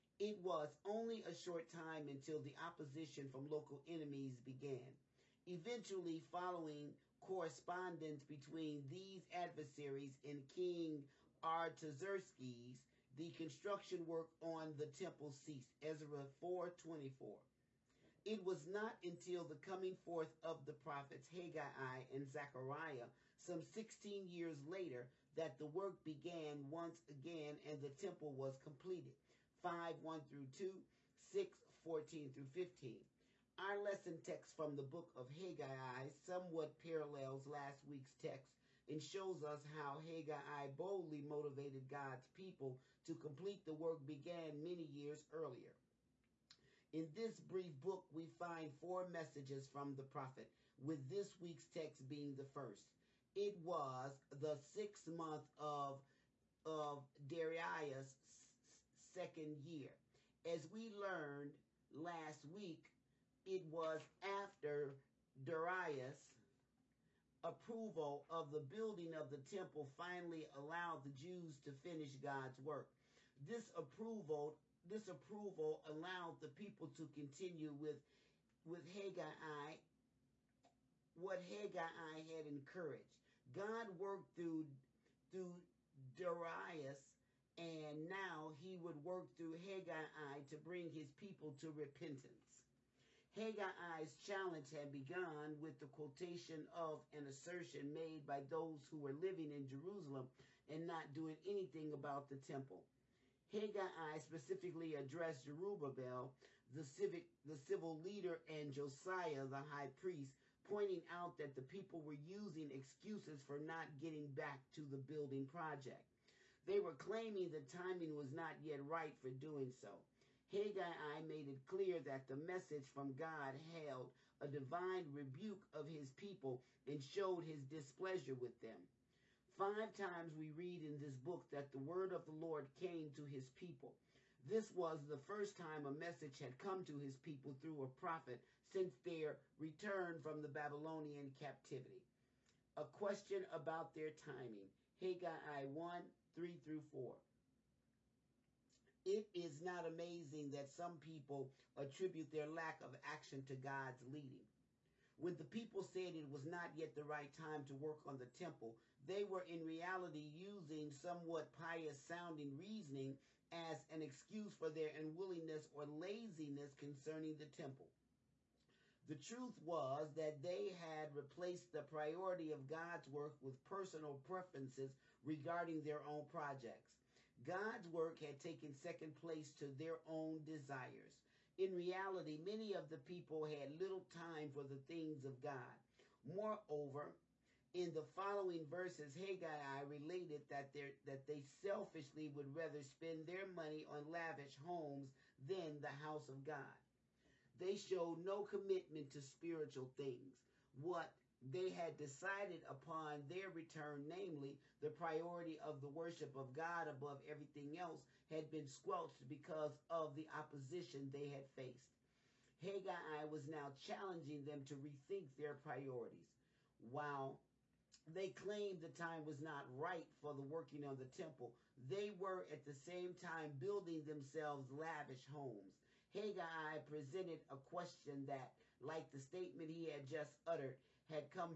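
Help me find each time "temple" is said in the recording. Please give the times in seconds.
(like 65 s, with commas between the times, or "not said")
14 s, 27 s, 69 s, 102 s, 158 s, 167 s, 221 s.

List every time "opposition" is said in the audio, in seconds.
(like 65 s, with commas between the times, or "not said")
2 s, 210 s.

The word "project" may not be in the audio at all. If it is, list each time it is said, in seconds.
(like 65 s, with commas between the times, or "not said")
115 s, 176 s.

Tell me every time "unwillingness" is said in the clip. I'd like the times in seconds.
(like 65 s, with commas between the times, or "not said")
164 s.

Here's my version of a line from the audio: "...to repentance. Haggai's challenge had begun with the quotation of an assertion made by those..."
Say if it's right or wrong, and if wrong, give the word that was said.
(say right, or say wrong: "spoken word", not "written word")
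right.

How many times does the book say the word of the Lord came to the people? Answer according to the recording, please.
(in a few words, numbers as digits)
5.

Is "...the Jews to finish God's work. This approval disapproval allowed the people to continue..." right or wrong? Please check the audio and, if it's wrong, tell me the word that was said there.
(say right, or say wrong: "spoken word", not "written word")
right.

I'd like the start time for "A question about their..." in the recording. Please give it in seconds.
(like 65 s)
142 s.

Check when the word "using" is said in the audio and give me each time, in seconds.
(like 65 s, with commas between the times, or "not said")
112 s, 160 s.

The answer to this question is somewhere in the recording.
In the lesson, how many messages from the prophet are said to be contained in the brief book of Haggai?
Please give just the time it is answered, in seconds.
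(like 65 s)
48 s.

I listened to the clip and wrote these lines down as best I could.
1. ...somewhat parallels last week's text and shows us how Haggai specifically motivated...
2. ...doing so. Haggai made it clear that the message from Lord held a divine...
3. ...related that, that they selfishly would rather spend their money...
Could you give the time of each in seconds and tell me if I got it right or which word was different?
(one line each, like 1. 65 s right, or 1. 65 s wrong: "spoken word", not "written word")
1. 36 s wrong: "boldly", not "specifically"
2. 119 s wrong: "God", not "Lord"
3. 189 s right.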